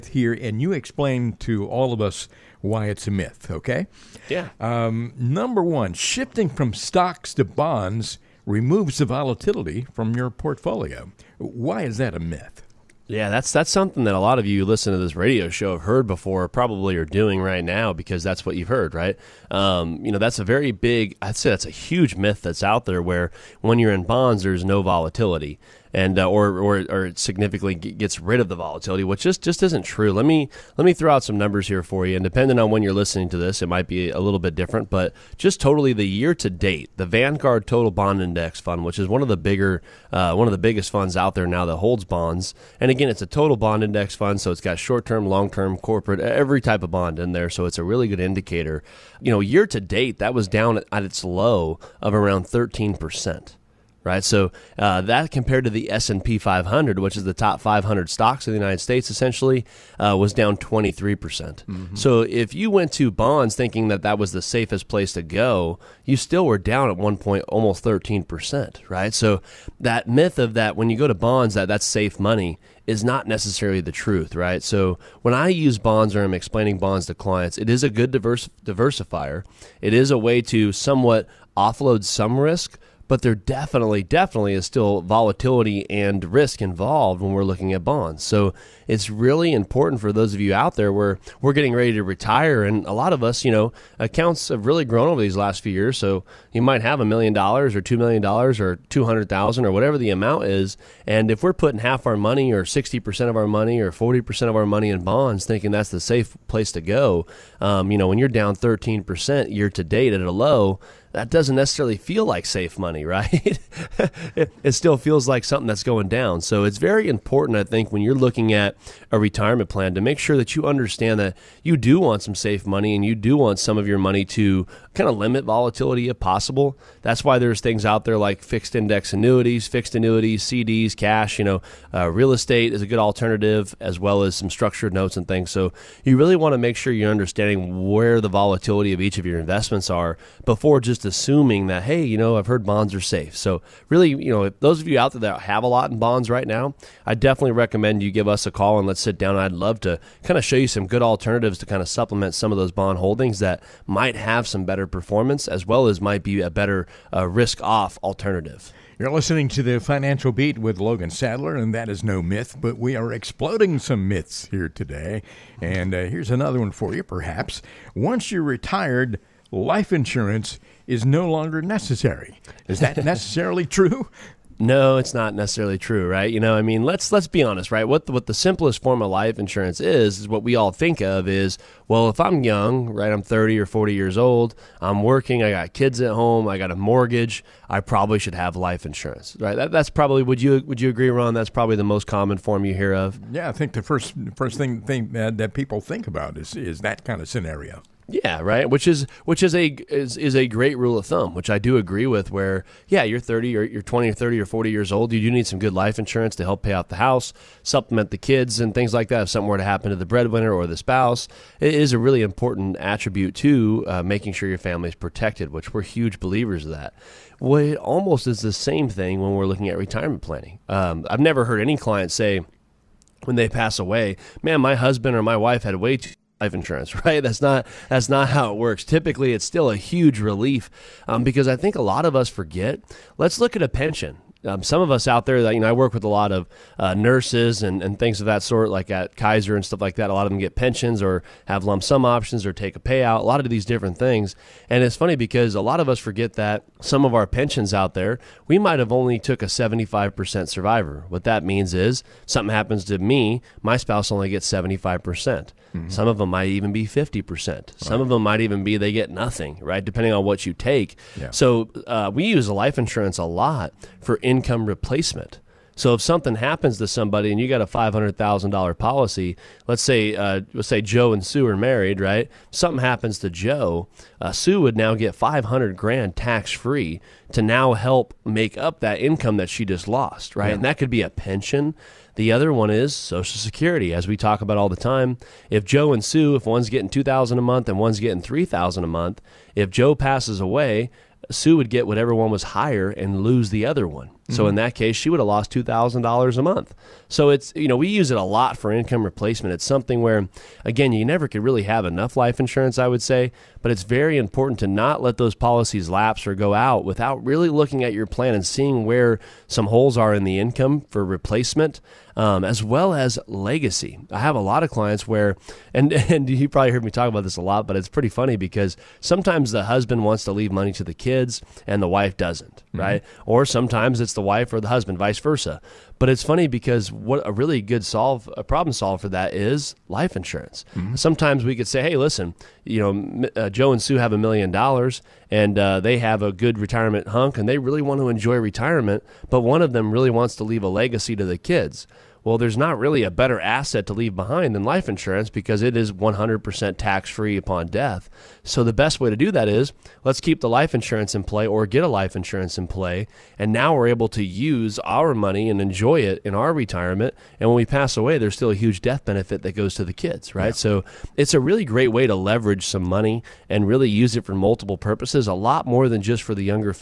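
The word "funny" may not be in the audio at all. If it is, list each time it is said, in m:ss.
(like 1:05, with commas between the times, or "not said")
4:04, 5:18, 5:26.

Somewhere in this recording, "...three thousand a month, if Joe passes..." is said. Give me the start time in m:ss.
4:48.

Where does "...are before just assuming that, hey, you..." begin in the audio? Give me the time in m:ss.
2:19.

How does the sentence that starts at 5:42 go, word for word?
Well, there's not really a better asset to leave behind than life insurance because it is 100% tax free upon death.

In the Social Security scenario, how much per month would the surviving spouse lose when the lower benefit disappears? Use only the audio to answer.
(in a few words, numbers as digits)
$2,000.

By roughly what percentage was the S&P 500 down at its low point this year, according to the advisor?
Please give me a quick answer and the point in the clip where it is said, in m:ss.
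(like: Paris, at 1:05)
23 percent, at 1:00.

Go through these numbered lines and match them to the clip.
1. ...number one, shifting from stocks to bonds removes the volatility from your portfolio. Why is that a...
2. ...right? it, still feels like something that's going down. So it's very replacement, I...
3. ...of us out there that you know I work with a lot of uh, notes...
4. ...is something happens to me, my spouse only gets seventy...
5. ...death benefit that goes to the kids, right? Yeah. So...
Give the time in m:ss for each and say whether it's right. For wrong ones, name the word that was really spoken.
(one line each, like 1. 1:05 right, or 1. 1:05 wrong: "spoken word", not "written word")
1. 0:05 right
2. 1:53 wrong: "important", not "replacement"
3. 3:54 wrong: "nurses", not "notes"
4. 4:11 right
5. 5:58 right.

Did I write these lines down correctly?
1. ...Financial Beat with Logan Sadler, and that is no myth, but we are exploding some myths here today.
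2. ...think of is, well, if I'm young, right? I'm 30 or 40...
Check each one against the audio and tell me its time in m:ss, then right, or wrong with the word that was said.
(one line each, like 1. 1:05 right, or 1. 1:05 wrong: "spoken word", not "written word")
1. 2:39 right
2. 3:00 right.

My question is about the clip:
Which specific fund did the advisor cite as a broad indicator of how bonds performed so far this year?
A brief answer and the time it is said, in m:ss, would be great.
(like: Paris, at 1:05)
Vanguard Total Bond Index Fund, at 0:37.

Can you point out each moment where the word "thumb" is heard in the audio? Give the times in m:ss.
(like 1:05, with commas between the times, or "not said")
3:21.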